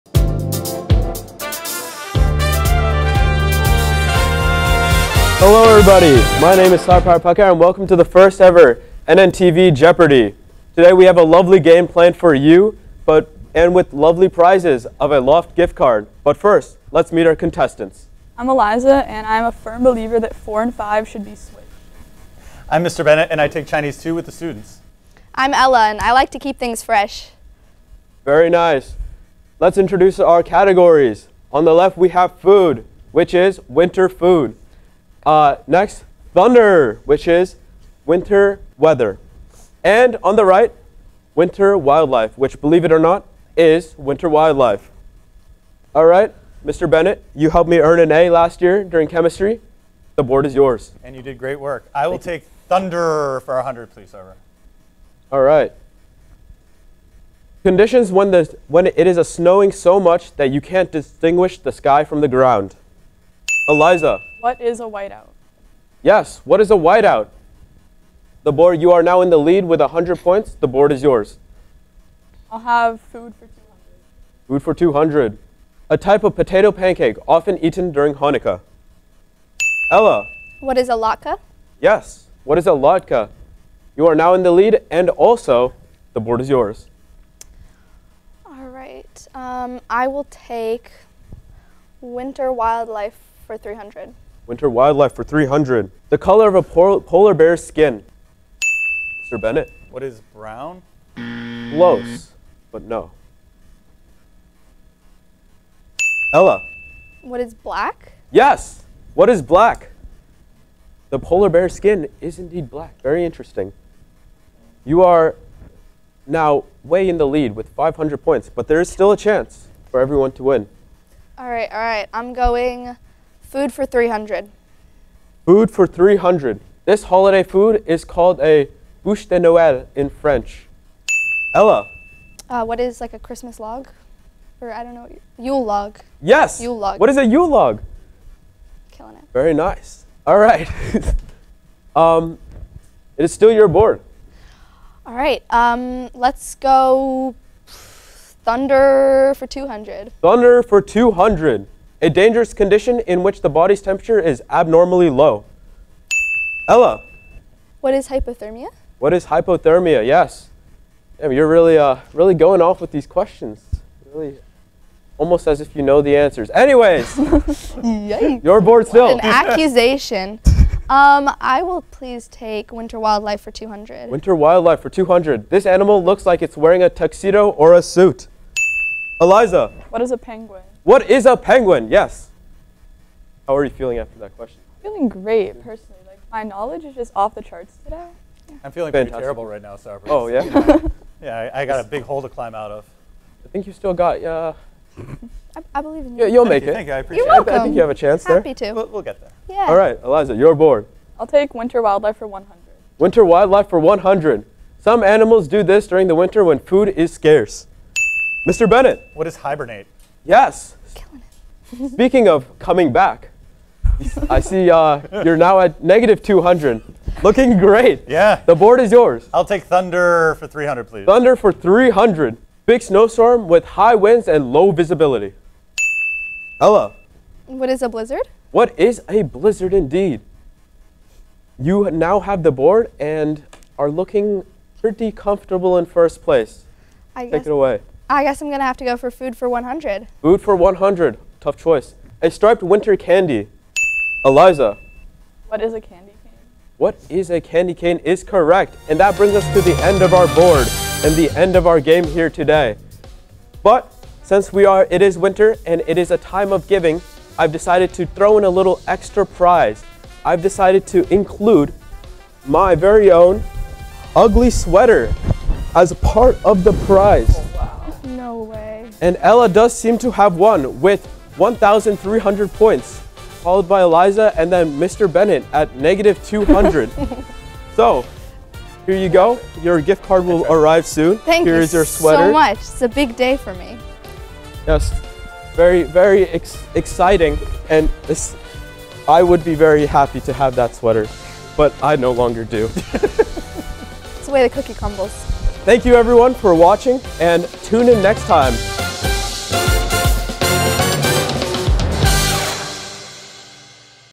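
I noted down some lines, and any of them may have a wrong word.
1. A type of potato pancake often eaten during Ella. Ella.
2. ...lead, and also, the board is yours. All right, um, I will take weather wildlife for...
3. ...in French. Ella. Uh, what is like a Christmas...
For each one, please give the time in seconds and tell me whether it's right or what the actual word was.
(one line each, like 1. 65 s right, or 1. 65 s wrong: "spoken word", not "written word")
1. 75 s wrong: "Hanukkah", not "Ella"
2. 84 s wrong: "winter", not "weather"
3. 129 s right.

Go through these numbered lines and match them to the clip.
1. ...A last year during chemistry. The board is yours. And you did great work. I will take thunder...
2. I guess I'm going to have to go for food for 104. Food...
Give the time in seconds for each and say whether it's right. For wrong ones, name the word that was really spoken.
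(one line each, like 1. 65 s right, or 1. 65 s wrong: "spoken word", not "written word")
1. 48 s right
2. 238 s wrong: "100", not "104".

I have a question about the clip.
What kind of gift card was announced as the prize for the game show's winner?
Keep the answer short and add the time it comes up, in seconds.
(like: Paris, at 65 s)
Loft, at 15 s.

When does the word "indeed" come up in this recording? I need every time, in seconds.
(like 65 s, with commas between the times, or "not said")
112 s, 229 s.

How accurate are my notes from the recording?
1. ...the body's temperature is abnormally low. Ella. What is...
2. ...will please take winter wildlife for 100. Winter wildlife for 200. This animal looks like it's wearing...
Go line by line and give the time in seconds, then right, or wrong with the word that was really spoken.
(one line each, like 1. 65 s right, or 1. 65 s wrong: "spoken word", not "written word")
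1. 153 s right
2. 171 s wrong: "200", not "100".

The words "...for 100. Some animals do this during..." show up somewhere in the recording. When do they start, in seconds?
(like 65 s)
203 s.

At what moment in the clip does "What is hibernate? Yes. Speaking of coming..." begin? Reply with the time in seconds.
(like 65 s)
209 s.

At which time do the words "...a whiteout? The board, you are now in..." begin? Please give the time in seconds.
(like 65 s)
66 s.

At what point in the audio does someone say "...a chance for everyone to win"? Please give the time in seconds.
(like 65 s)
119 s.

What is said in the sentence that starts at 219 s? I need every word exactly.
I'll take Thunder for 300, please.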